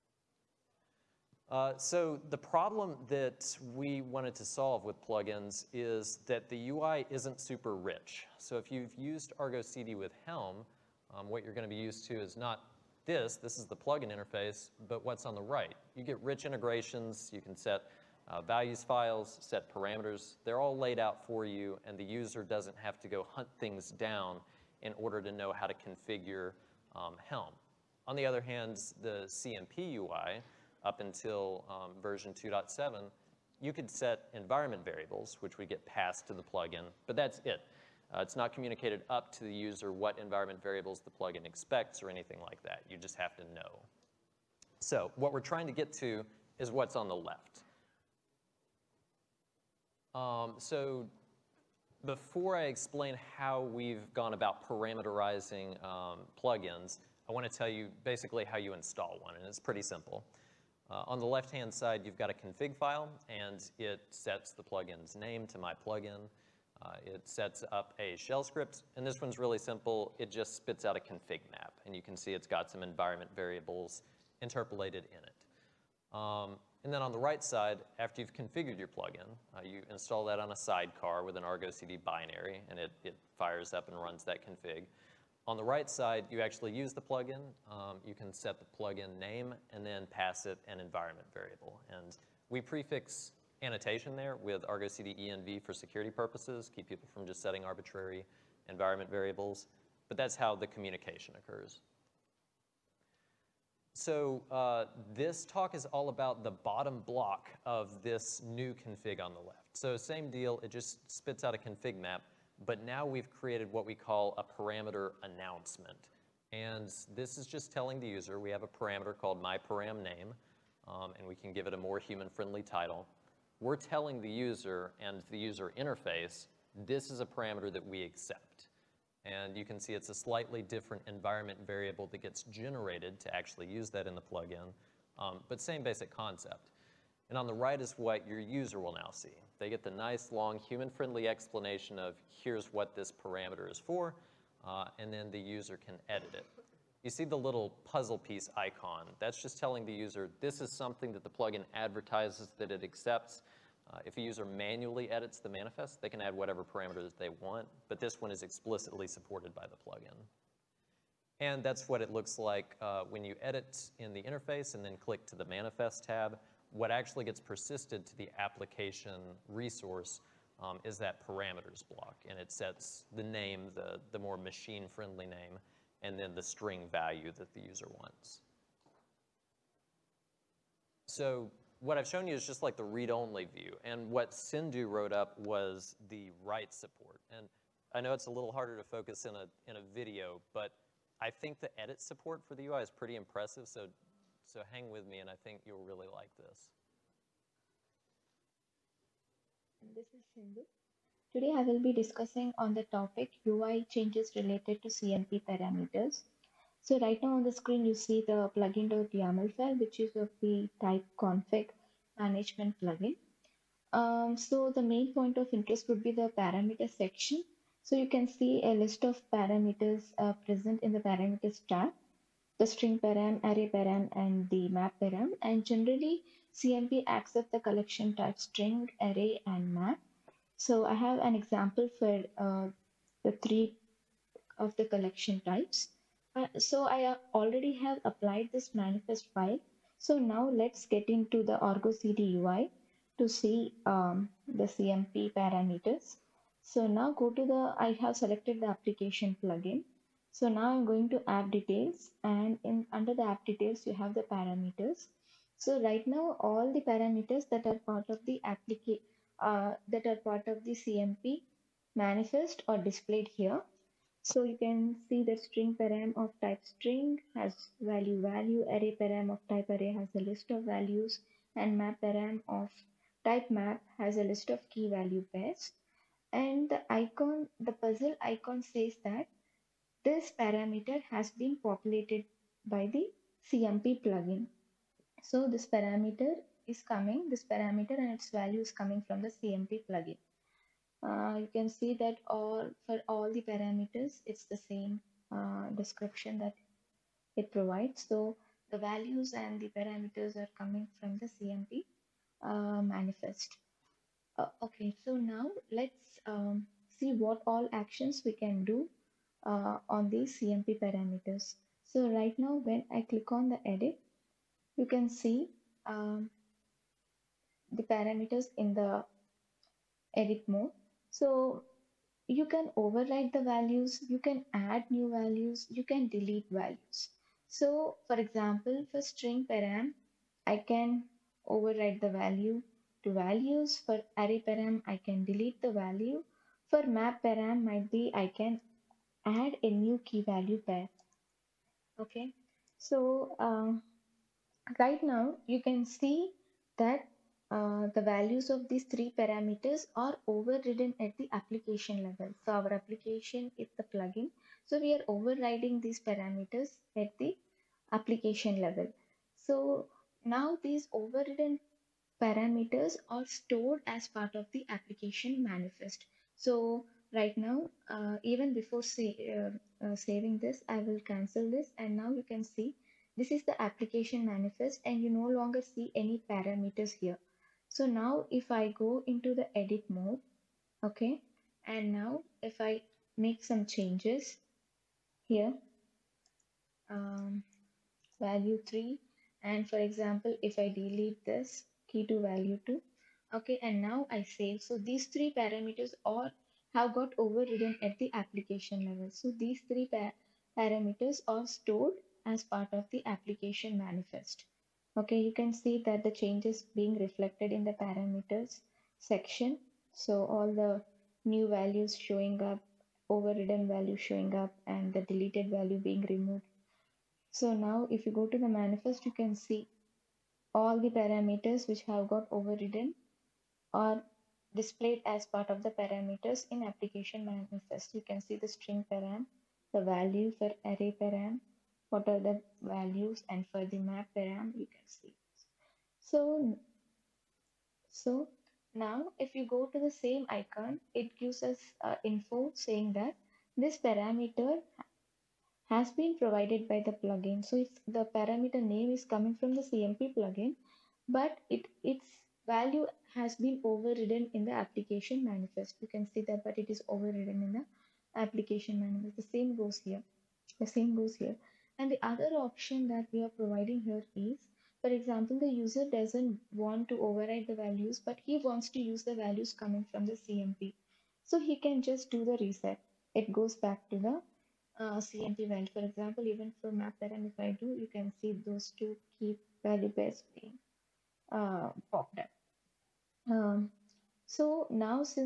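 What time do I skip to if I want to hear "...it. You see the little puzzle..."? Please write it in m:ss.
2:26.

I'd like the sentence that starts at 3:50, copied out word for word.
So I have an example for uh, the three of the collection types.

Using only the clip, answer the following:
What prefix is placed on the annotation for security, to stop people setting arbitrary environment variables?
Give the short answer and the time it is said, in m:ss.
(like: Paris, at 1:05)
Argo CD env, at 1:34.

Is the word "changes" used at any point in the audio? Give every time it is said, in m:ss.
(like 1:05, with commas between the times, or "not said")
3:23, 6:23, 6:46.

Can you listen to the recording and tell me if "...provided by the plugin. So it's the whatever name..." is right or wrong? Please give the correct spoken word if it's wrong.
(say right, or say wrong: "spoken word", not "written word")
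wrong: "parameter", not "whatever".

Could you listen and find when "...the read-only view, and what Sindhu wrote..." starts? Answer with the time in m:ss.
3:02.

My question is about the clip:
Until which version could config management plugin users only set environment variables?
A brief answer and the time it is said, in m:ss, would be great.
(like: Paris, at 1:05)
2.7, at 0:32.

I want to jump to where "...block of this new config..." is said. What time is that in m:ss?
1:47.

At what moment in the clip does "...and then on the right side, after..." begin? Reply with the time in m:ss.
1:16.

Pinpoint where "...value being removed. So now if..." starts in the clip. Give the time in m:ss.
6:55.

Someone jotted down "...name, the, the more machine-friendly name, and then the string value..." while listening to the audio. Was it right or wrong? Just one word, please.
right.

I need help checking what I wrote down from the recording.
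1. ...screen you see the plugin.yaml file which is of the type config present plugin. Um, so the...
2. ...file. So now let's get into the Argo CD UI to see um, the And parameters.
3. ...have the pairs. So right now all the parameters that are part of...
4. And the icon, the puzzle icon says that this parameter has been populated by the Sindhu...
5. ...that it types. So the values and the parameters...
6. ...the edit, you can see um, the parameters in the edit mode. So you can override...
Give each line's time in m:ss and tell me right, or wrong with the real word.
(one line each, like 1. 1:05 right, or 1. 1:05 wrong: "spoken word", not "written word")
1. 3:27 wrong: "management", not "present"
2. 3:59 wrong: "CMP", not "And"
3. 4:13 wrong: "parameters", not "pairs"
4. 4:36 wrong: "CMP", not "Sindhu"
5. 4:56 wrong: "provides", not "types"
6. 5:13 right.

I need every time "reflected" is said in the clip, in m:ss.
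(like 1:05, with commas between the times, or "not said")
6:47.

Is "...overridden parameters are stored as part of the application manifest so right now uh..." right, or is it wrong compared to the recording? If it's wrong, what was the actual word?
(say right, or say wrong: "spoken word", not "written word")
right.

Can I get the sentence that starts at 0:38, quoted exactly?
Uh, it's not communicated up to the user what environment variables the plugin expects or anything like that.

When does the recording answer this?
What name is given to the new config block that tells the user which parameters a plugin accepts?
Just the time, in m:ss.
1:54.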